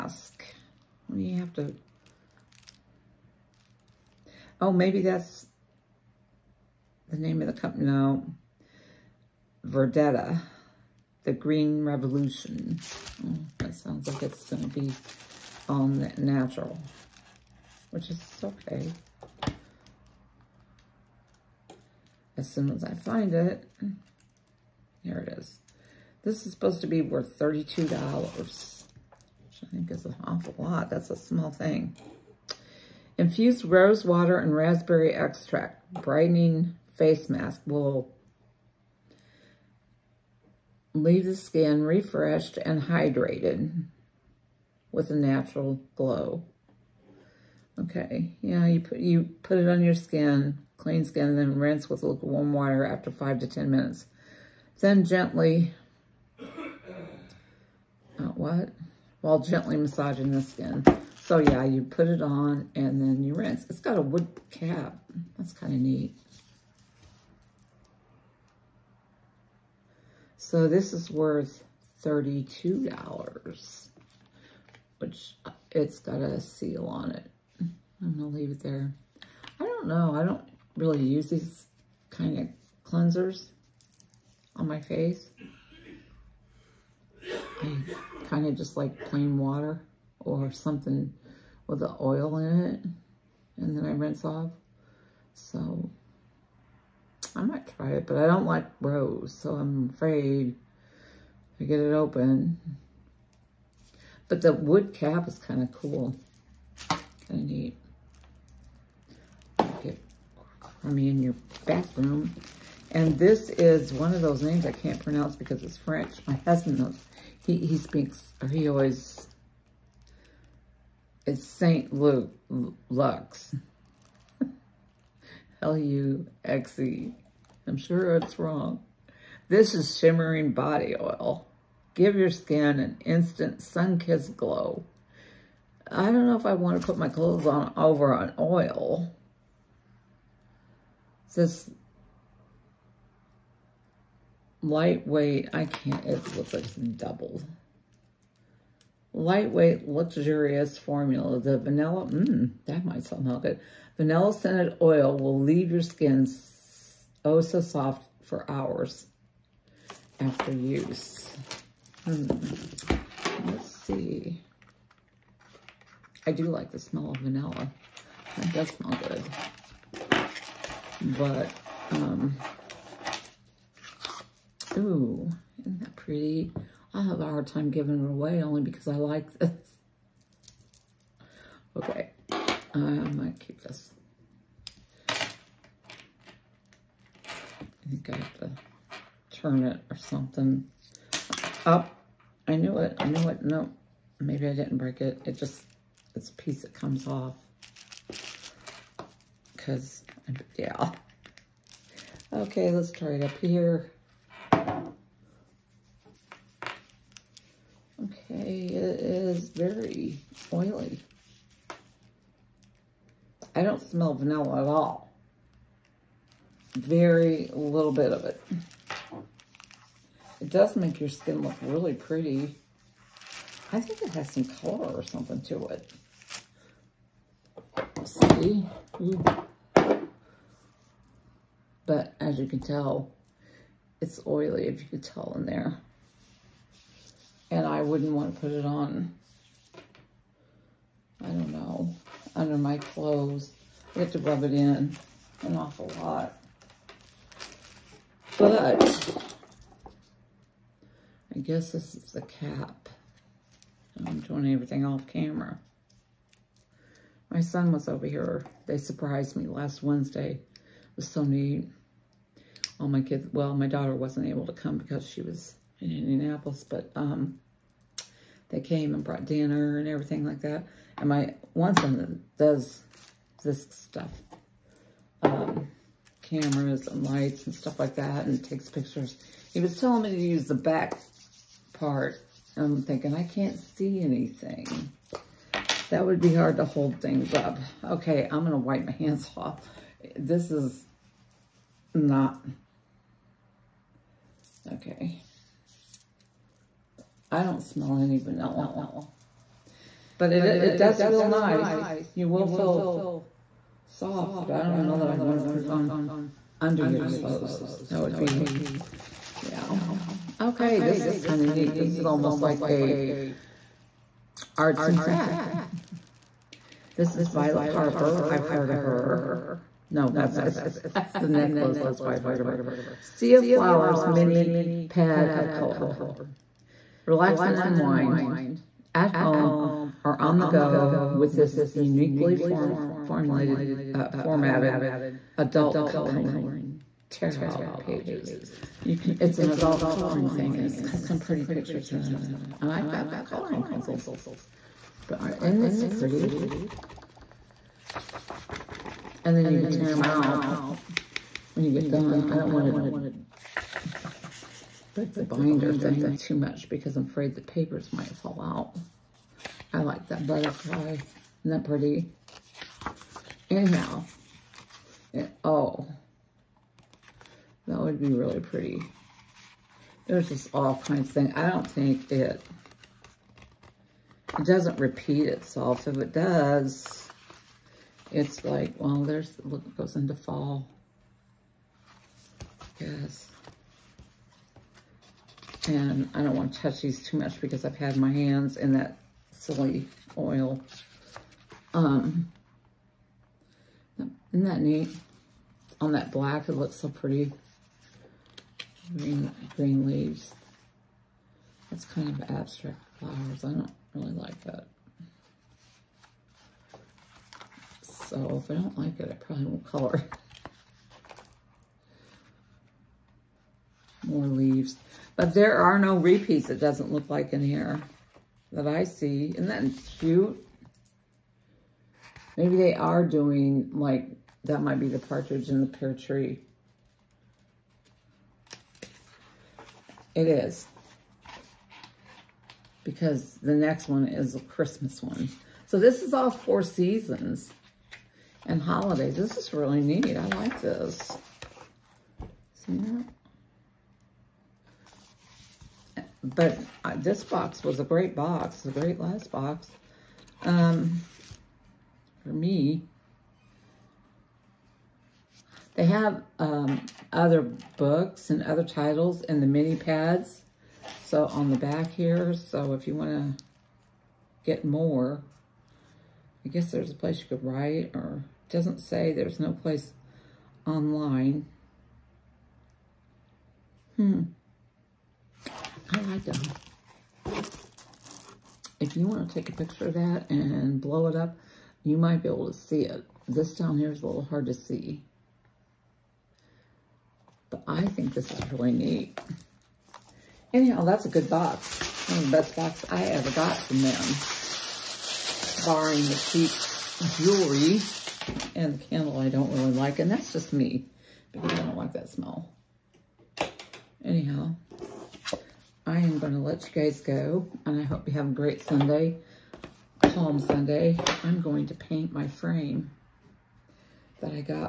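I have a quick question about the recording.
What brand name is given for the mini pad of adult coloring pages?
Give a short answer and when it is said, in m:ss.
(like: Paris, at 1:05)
Violet Harper, at 5:17.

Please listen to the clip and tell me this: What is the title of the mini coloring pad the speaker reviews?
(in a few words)
Sea of Flowers.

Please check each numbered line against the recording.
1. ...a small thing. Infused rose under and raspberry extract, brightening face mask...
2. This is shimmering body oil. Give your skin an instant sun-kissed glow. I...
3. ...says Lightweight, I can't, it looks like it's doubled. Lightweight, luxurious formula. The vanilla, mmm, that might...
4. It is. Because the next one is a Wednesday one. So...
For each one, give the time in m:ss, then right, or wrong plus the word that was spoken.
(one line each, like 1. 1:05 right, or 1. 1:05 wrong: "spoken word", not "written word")
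1. 0:31 wrong: "water", not "under"
2. 2:09 right
3. 2:21 right
4. 7:10 wrong: "Christmas", not "Wednesday".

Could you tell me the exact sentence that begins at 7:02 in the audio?
Maybe they are doing, like, that might be the partridge in the pear tree.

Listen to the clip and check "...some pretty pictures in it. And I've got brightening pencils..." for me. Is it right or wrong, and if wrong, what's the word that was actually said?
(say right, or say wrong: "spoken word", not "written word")
wrong: "coloring", not "brightening".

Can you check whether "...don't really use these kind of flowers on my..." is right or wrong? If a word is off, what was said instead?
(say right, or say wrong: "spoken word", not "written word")
wrong: "cleansers", not "flowers".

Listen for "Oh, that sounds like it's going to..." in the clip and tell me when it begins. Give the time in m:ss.
0:13.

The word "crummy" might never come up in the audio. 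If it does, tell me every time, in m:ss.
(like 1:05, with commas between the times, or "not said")
1:50.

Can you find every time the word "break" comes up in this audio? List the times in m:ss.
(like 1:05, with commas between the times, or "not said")
3:14, 5:54.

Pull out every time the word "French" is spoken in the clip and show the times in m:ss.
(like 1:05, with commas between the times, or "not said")
1:55.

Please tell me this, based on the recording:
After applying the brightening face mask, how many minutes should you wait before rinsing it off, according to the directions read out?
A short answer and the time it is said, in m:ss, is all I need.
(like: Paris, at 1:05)
5 to 10 minutes, at 0:53.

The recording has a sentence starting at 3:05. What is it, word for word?
I think I have to turn it or something.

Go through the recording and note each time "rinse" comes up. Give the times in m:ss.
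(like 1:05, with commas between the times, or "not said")
0:51, 1:03, 1:33.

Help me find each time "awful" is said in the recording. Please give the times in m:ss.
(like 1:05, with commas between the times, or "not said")
0:30, 4:05.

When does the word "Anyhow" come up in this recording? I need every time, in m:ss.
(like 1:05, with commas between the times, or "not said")
6:03, 8:10, 8:24.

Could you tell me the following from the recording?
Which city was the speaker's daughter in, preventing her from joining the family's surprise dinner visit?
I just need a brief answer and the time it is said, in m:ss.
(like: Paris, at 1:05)
Indianapolis, at 4:25.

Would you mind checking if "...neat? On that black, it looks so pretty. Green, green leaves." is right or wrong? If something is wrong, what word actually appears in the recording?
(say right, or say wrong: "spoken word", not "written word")
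right.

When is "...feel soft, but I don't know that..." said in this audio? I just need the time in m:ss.
5:02.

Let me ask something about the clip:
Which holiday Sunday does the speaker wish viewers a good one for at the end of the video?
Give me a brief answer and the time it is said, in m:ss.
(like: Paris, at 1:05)
Palm Sunday, at 8:30.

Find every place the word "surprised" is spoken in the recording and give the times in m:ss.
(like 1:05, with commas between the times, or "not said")
4:18.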